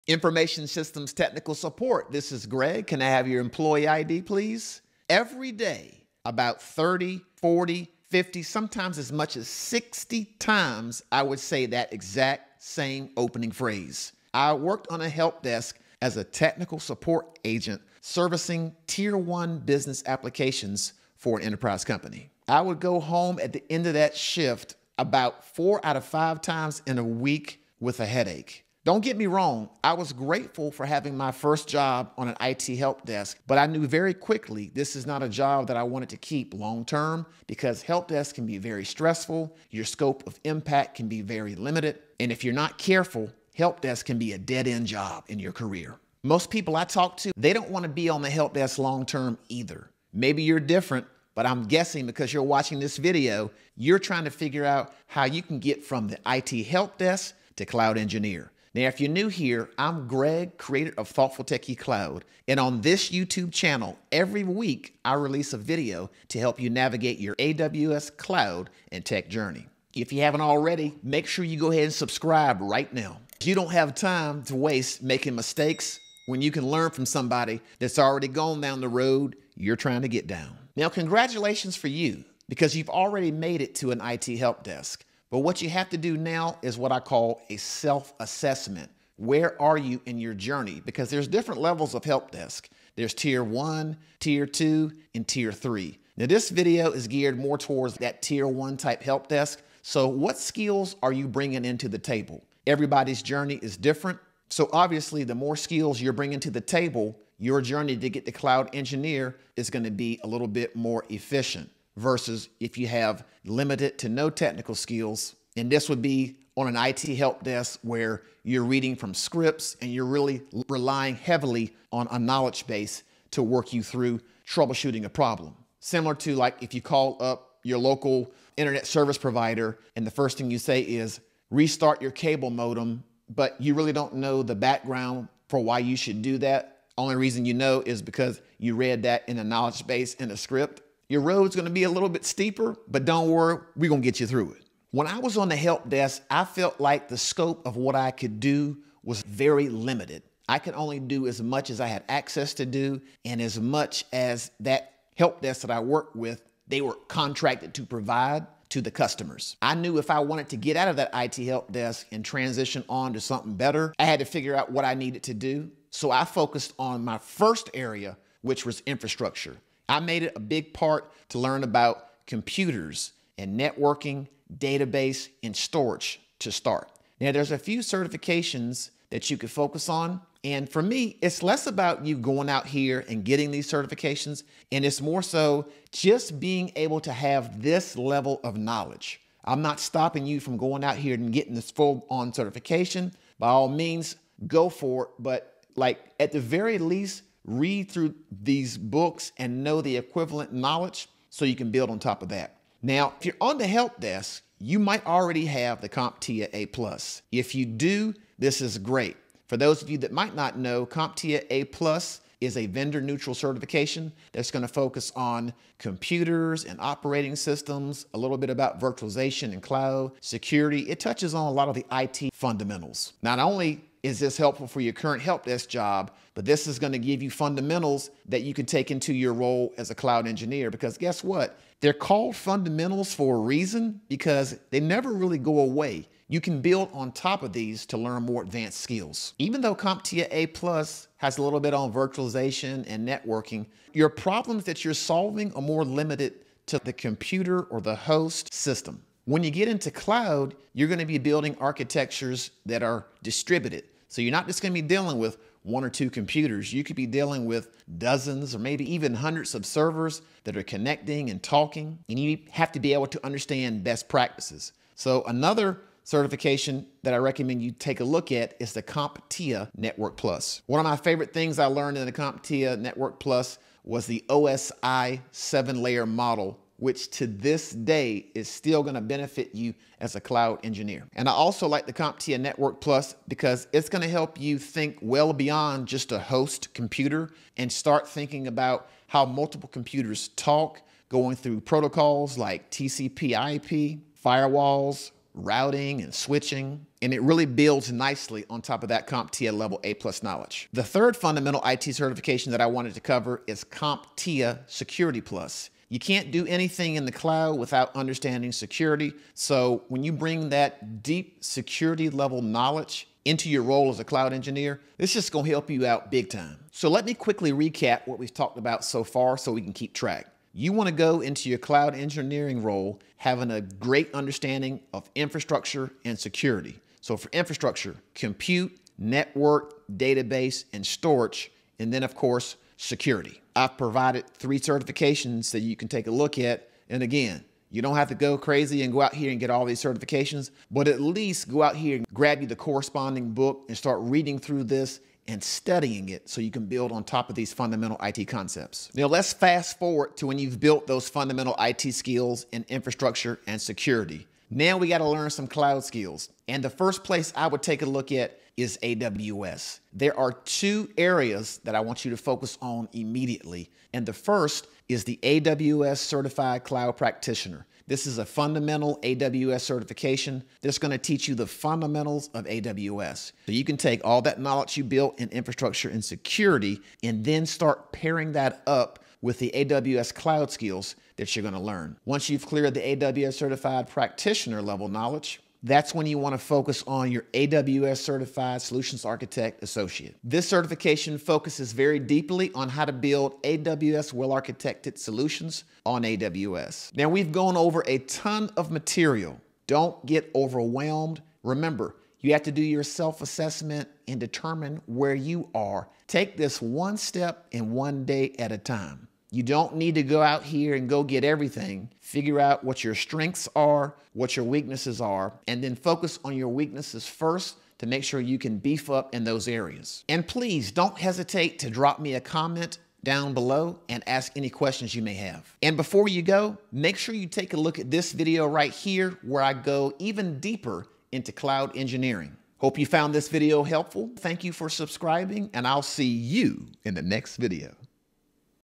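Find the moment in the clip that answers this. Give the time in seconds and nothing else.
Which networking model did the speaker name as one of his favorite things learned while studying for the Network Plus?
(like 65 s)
274 s.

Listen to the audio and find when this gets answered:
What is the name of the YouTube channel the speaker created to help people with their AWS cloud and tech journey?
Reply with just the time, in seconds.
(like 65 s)
61 s.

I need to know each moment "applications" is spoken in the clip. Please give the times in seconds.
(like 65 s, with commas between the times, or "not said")
20 s.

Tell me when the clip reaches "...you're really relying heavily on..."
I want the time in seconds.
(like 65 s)
119 s.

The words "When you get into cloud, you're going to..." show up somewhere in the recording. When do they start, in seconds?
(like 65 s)
249 s.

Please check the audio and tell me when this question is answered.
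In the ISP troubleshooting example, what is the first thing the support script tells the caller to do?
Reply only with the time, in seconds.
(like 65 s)
131 s.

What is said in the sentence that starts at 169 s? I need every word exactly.
I made it a big part to learn about computers and networking, database, and storage to start.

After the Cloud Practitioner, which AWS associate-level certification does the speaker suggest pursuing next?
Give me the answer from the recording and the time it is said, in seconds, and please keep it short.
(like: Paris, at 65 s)
AWS Certified Solutions Architect Associate, at 387 s.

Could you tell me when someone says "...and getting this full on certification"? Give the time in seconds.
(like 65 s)
191 s.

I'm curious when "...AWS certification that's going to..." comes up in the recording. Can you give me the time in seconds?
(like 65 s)
369 s.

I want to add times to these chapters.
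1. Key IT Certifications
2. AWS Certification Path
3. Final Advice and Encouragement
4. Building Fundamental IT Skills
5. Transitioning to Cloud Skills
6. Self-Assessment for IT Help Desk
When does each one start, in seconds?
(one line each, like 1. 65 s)
1. 202 s
2. 363 s
3. 399 s
4. 165 s
5. 348 s
6. 80 s.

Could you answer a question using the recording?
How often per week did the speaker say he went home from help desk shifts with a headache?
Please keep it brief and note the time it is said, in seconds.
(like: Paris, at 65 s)
4 out of 5 times, at 25 s.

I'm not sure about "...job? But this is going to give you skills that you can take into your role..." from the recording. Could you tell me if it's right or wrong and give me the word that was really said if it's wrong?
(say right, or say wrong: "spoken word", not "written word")
wrong: "fundamentals", not "skills".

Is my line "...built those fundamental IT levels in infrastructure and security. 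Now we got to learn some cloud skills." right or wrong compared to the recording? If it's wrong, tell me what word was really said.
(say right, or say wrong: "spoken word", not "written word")
wrong: "skills", not "levels".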